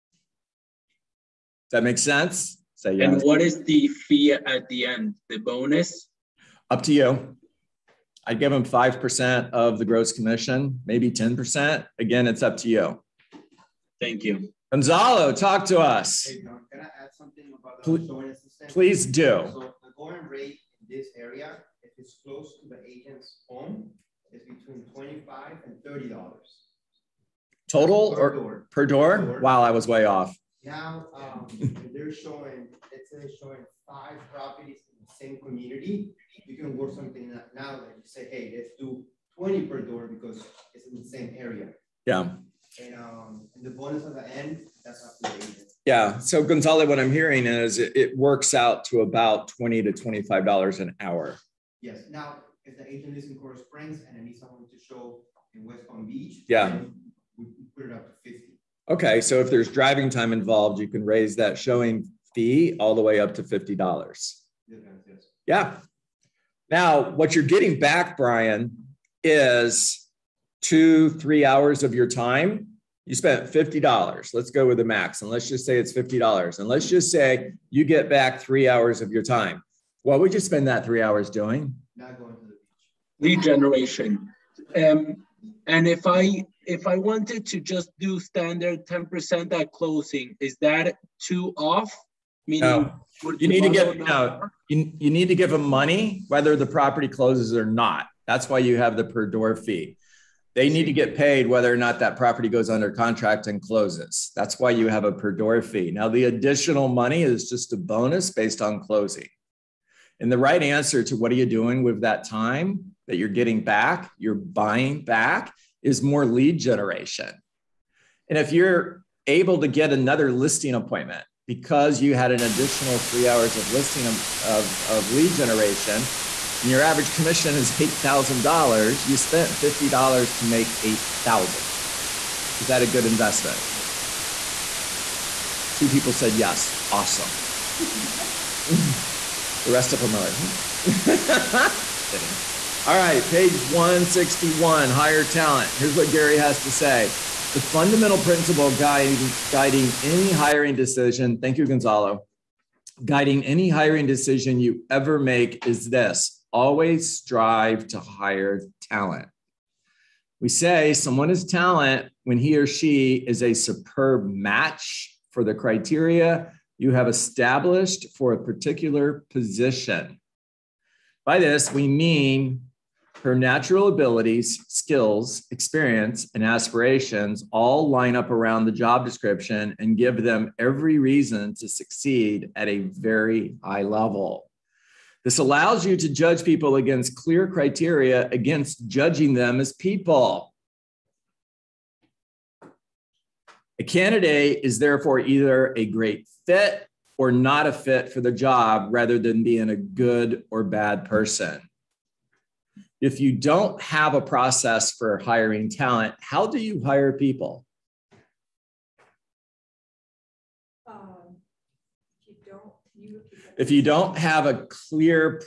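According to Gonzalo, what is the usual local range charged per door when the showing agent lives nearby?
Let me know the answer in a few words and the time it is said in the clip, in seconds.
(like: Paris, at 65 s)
$25 to $30, at 24 s.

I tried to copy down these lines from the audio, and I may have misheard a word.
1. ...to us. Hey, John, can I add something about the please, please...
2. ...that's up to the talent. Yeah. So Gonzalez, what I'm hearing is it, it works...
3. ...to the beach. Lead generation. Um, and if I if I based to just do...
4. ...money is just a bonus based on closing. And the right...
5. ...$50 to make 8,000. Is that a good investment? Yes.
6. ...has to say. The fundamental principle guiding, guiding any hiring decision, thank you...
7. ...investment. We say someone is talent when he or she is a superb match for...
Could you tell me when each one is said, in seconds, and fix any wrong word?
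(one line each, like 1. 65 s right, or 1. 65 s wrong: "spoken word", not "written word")
1. 15 s right
2. 44 s wrong: "agent", not "talent"
3. 82 s wrong: "wanted", not "based"
4. 106 s right
5. 129 s right
6. 146 s right
7. 158 s wrong: "talent", not "investment".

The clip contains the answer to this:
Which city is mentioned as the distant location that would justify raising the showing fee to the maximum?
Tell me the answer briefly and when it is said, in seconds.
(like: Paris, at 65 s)
West Palm Beach, at 55 s.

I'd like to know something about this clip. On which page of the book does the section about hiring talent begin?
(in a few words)
161.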